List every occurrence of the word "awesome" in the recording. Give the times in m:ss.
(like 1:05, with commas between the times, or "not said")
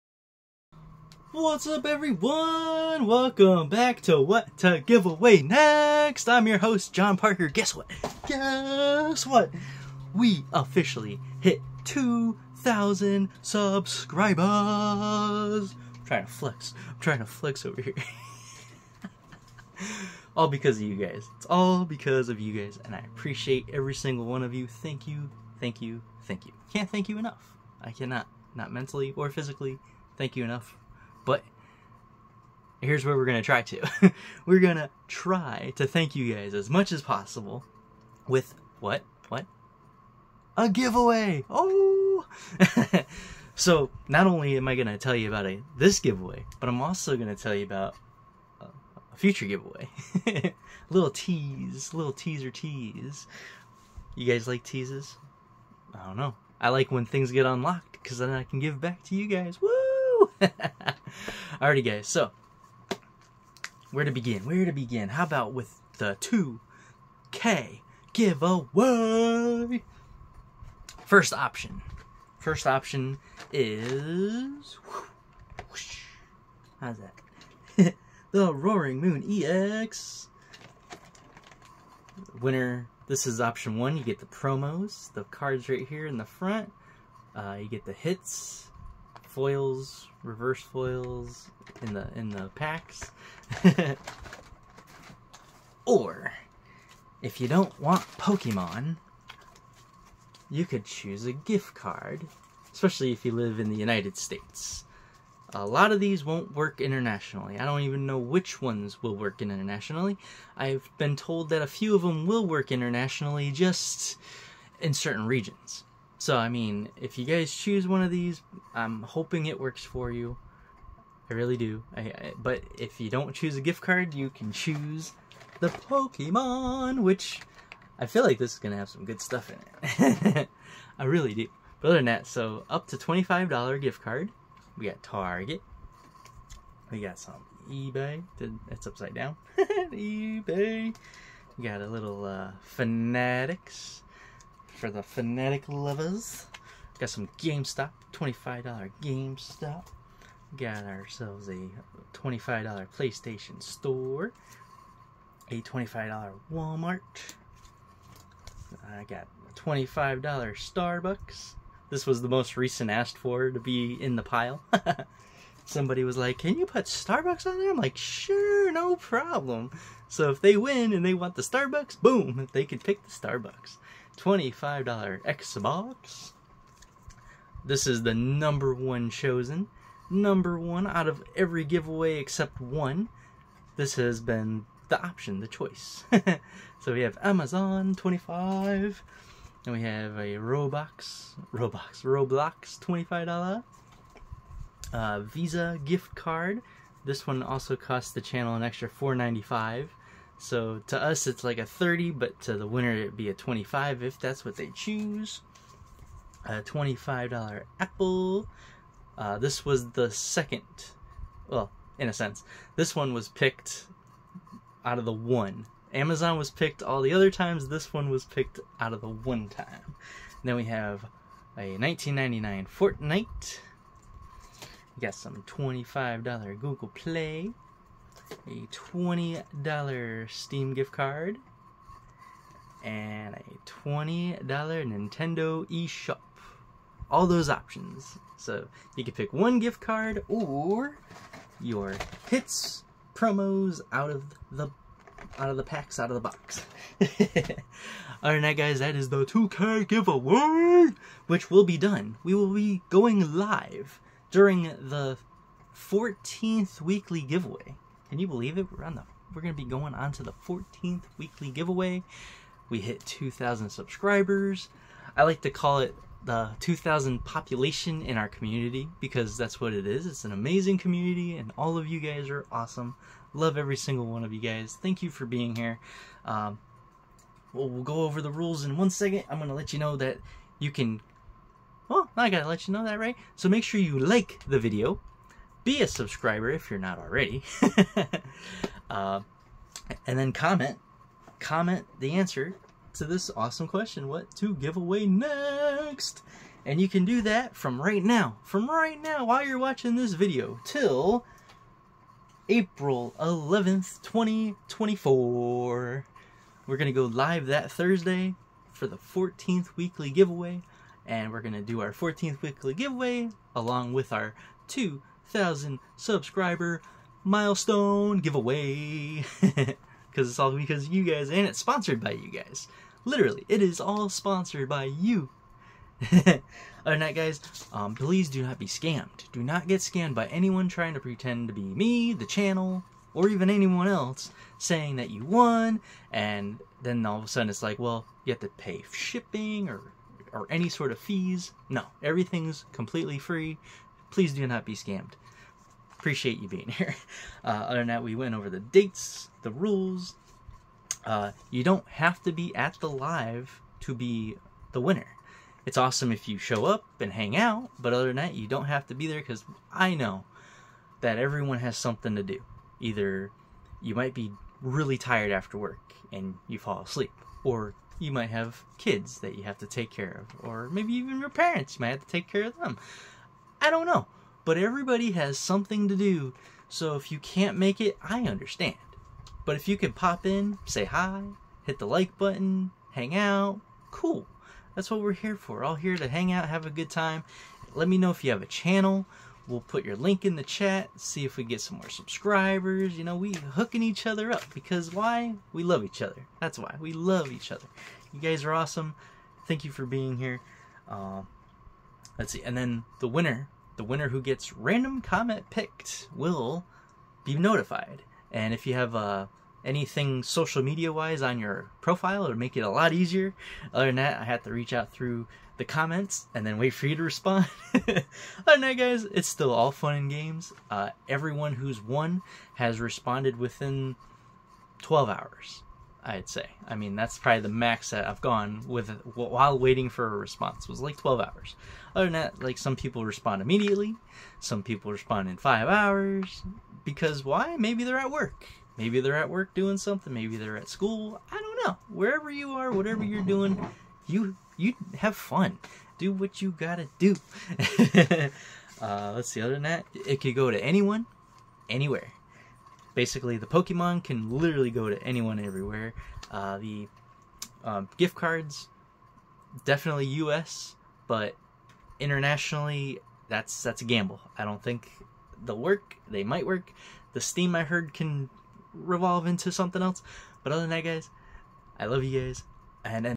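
4:32, 4:53, 5:55, 6:38.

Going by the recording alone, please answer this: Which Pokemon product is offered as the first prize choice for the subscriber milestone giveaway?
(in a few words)
Roaring Moon EX.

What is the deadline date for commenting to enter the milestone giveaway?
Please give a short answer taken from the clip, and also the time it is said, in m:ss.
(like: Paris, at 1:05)
April 11th, 2024, at 5:02.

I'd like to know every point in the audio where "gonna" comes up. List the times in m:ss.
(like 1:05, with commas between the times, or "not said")
4:19, 4:39, 5:06, 5:11.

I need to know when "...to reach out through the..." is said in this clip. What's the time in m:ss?
6:54.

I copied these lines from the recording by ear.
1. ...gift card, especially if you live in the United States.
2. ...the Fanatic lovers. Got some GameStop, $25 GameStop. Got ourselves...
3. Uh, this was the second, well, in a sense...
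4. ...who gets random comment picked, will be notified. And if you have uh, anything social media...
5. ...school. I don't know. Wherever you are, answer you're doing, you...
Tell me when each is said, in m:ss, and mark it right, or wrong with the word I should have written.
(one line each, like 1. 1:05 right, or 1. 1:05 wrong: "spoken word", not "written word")
1. 1:41 right
2. 2:24 right
3. 3:29 right
4. 6:44 right
5. 7:20 wrong: "whatever", not "answer".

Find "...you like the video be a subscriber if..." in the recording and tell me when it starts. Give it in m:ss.
4:43.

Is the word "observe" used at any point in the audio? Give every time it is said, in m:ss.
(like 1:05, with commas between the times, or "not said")
not said.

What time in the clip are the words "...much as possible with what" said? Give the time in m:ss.
0:36.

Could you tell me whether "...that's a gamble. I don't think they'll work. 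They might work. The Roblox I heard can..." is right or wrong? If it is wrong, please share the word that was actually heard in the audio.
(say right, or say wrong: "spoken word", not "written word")
wrong: "Steam", not "Roblox".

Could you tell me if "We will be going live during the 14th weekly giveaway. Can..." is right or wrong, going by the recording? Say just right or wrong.
right.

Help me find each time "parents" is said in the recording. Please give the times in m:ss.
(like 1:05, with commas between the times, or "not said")
6:11.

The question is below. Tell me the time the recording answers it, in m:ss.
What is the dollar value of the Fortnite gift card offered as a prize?
3:41.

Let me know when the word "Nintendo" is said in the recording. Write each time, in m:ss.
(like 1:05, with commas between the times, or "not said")
3:54.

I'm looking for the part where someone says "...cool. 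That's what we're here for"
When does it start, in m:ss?
6:23.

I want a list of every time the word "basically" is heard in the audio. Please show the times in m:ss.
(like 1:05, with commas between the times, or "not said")
7:32.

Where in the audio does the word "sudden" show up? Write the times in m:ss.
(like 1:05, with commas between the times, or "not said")
5:37.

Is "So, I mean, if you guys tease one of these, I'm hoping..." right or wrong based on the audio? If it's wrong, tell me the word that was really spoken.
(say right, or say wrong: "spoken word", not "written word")
wrong: "choose", not "tease".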